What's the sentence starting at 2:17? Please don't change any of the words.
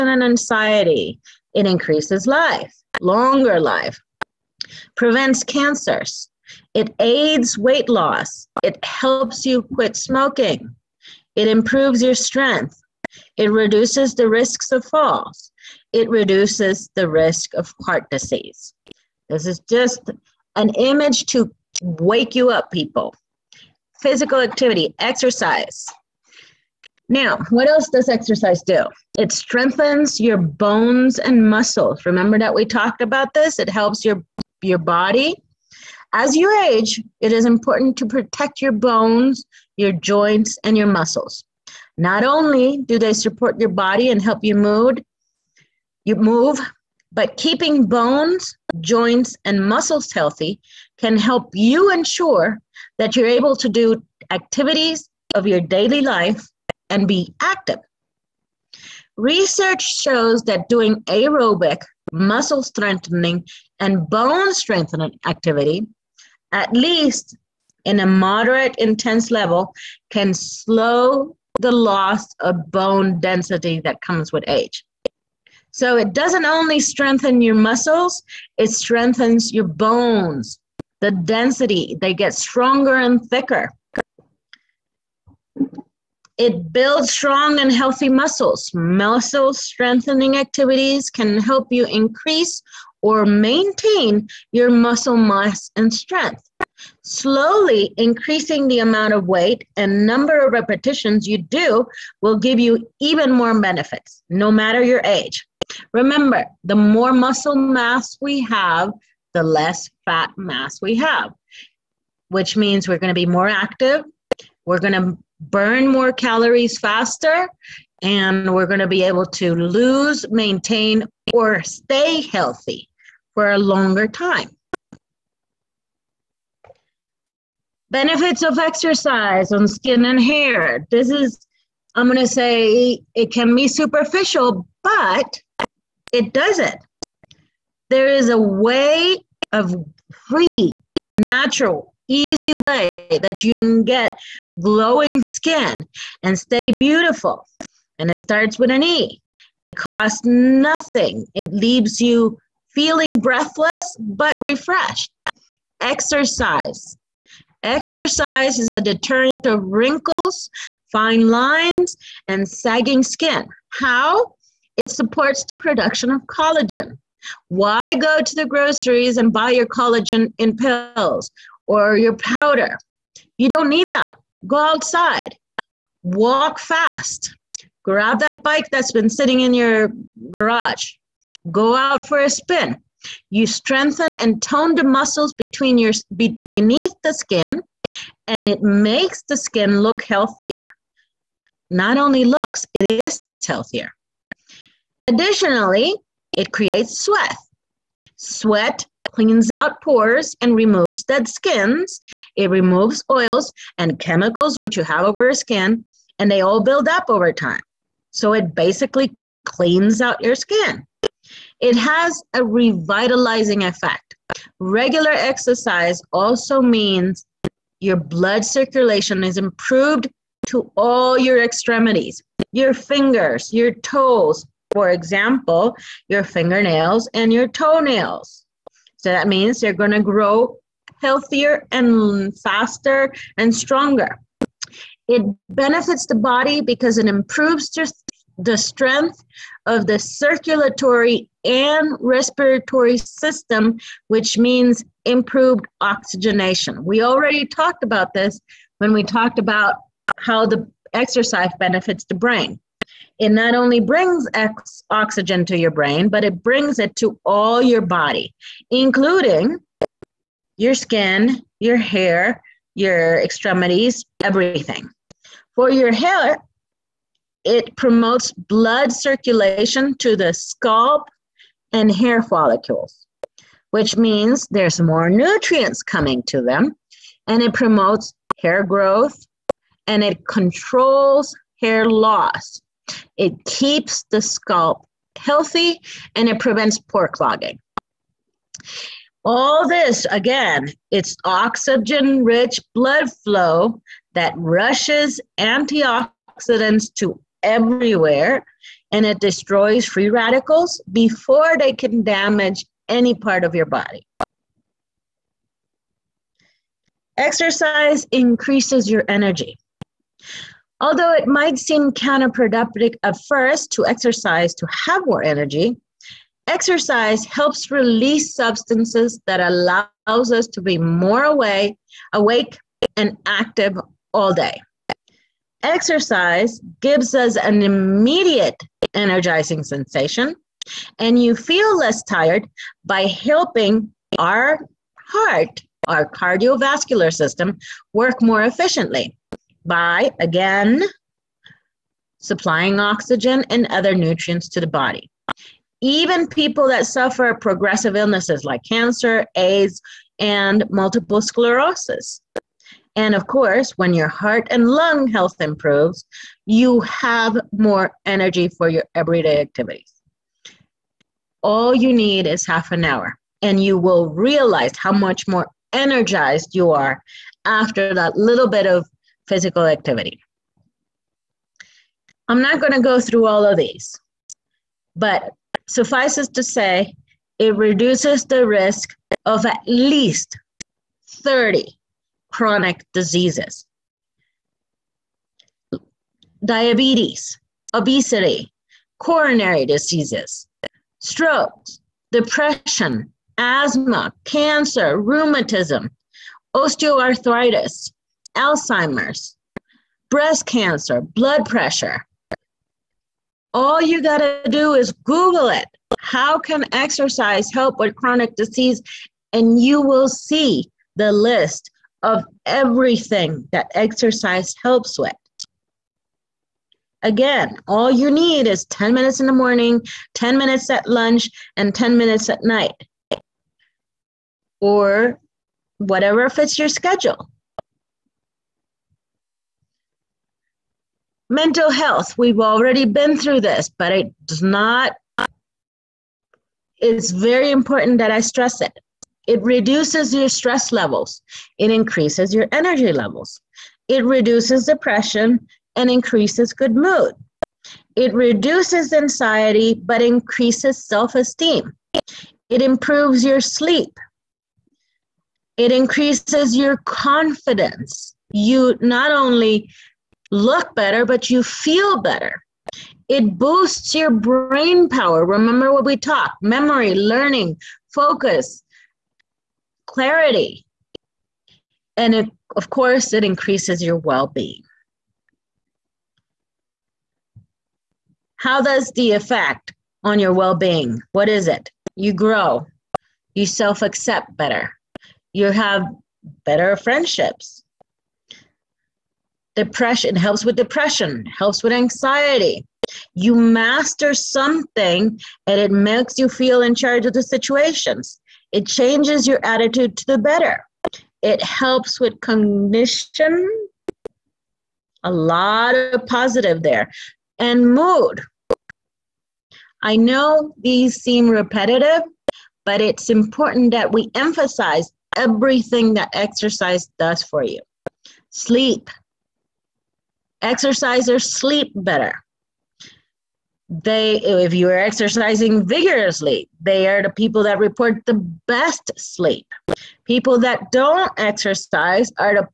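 There is a way of free, natural, easy way that you can get glowing skin and stay beautiful.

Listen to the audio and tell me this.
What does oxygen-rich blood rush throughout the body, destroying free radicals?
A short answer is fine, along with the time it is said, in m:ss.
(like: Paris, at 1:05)
antioxidants, at 4:55.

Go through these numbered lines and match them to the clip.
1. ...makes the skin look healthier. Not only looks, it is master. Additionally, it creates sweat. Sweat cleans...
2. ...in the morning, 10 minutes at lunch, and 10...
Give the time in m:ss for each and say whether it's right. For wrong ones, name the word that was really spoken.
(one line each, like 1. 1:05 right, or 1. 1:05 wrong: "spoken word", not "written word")
1. 3:08 wrong: "healthier", not "master"
2. 6:59 right.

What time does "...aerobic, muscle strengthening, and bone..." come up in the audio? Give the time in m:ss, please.
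1:01.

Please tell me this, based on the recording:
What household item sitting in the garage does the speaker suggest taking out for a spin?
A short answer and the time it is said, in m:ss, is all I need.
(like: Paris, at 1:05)
bike, at 2:58.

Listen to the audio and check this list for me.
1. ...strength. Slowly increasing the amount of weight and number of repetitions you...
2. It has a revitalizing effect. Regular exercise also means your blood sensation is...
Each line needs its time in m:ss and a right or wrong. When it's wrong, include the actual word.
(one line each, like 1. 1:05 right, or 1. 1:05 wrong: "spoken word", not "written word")
1. 1:35 right
2. 3:31 wrong: "circulation", not "sensation".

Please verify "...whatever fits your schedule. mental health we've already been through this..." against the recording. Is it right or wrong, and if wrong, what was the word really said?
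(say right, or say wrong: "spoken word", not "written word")
right.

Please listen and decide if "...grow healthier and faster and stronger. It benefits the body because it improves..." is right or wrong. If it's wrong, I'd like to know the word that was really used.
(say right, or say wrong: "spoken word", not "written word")
right.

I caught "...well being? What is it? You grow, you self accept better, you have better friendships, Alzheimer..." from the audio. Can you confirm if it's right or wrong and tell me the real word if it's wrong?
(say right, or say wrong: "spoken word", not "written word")
wrong: "Depression", not "Alzheimer".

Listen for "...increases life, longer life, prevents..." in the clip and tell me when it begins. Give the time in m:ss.
0:01.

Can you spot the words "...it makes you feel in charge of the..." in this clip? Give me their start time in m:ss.
8:15.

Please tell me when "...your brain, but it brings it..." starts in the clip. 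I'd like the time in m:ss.
4:15.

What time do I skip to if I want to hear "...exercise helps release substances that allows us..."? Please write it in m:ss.
5:16.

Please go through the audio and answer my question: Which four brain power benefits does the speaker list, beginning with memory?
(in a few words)
memory, learning, focus, clarity.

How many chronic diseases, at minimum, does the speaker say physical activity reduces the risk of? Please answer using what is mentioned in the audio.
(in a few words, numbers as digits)
30.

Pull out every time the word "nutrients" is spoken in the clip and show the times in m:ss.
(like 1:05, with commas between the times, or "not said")
4:35, 5:43.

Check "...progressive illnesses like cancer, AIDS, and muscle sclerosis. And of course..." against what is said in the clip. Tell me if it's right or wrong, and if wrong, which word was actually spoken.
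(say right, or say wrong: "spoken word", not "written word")
wrong: "multiple", not "muscle".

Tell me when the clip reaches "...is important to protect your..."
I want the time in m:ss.
0:37.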